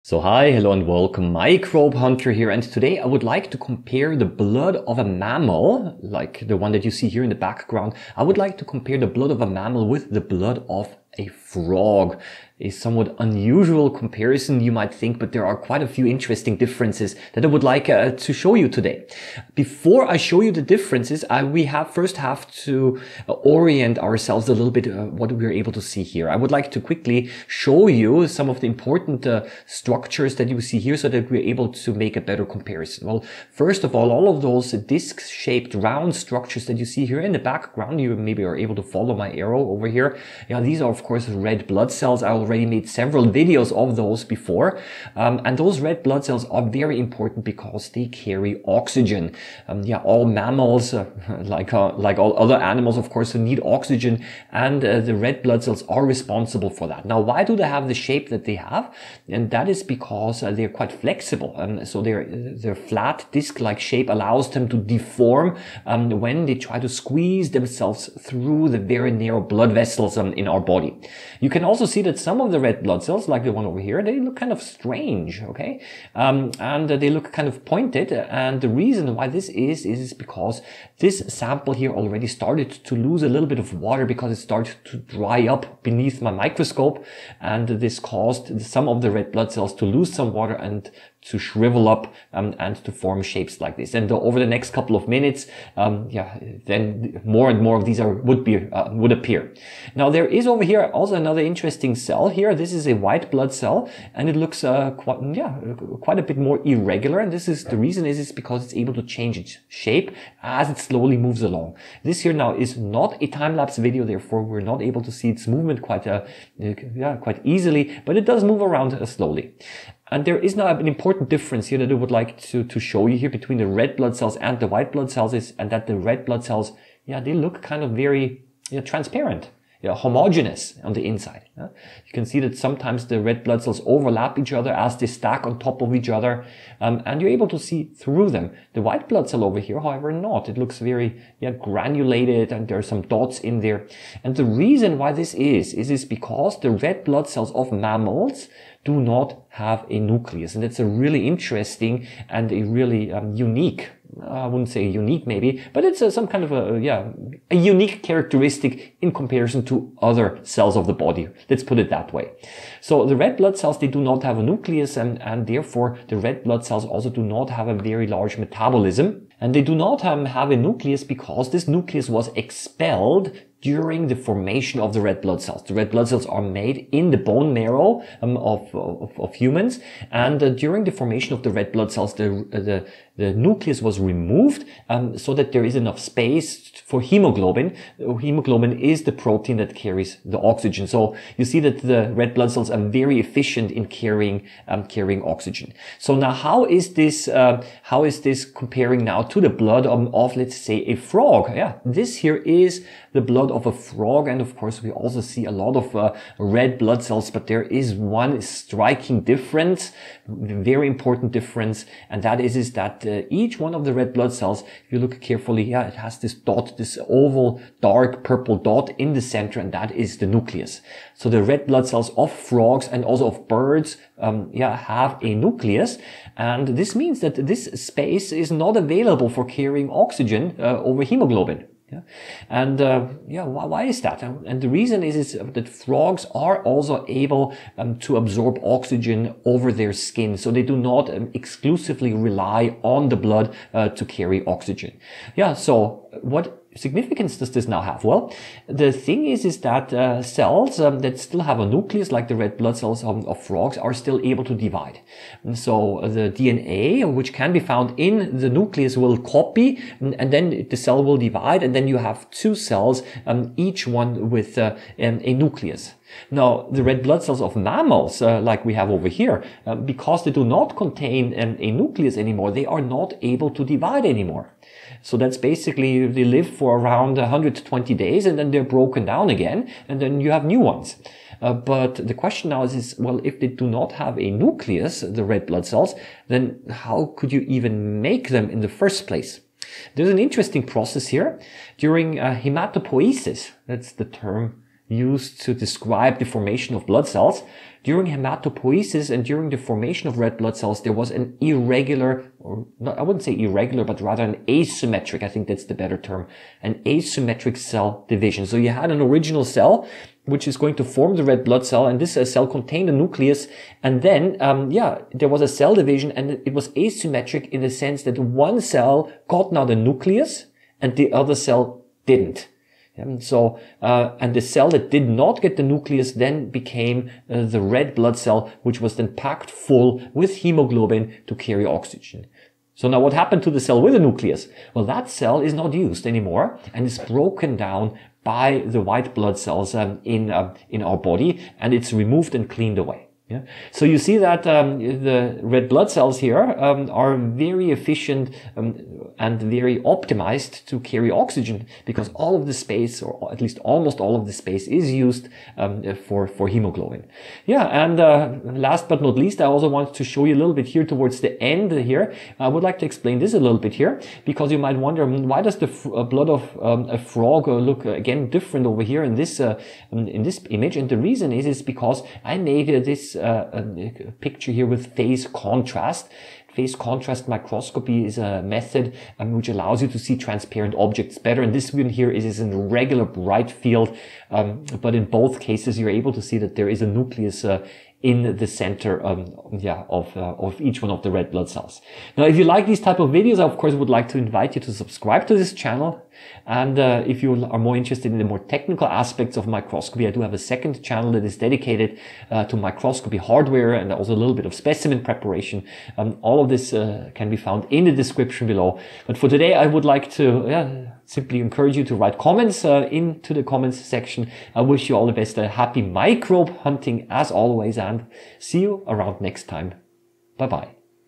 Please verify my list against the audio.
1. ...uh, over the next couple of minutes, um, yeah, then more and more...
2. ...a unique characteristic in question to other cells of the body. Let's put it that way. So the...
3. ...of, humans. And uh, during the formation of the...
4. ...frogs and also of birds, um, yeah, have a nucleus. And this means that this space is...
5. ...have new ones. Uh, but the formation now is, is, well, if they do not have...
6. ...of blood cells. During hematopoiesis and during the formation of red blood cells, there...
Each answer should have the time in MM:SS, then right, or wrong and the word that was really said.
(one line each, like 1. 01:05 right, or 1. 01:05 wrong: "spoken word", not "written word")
1. 01:34 right
2. 02:37 wrong: "comparison", not "question"
3. 02:59 right
4. 03:42 right
5. 04:40 wrong: "question", not "formation"
6. 04:56 right.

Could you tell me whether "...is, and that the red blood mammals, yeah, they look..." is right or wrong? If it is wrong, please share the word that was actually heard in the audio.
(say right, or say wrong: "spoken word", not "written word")
wrong: "cells", not "mammals".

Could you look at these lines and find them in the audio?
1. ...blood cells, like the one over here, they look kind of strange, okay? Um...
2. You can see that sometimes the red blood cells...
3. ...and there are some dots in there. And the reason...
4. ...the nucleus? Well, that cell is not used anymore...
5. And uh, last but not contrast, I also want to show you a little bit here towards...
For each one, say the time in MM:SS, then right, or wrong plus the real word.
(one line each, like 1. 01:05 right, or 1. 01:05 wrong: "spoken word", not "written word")
1. 01:12 right
2. 02:12 right
3. 02:22 right
4. 05:33 right
5. 05:57 wrong: "least", not "contrast".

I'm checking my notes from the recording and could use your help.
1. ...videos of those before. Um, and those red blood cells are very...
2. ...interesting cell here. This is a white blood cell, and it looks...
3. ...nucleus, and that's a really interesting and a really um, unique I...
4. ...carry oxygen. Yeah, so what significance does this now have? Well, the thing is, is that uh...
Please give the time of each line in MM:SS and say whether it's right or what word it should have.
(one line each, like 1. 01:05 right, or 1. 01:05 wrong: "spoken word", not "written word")
1. 00:43 right
2. 01:41 right
3. 02:29 right
4. 04:04 right.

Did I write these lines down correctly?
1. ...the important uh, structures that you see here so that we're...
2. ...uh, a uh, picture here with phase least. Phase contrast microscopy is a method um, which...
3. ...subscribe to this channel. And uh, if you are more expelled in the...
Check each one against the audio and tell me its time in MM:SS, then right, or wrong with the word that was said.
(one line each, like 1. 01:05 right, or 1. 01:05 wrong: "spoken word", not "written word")
1. 00:28 right
2. 06:13 wrong: "contrast", not "least"
3. 06:34 wrong: "interested", not "expelled".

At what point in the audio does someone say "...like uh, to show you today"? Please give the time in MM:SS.
00:17.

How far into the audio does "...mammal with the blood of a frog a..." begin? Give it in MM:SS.
00:09.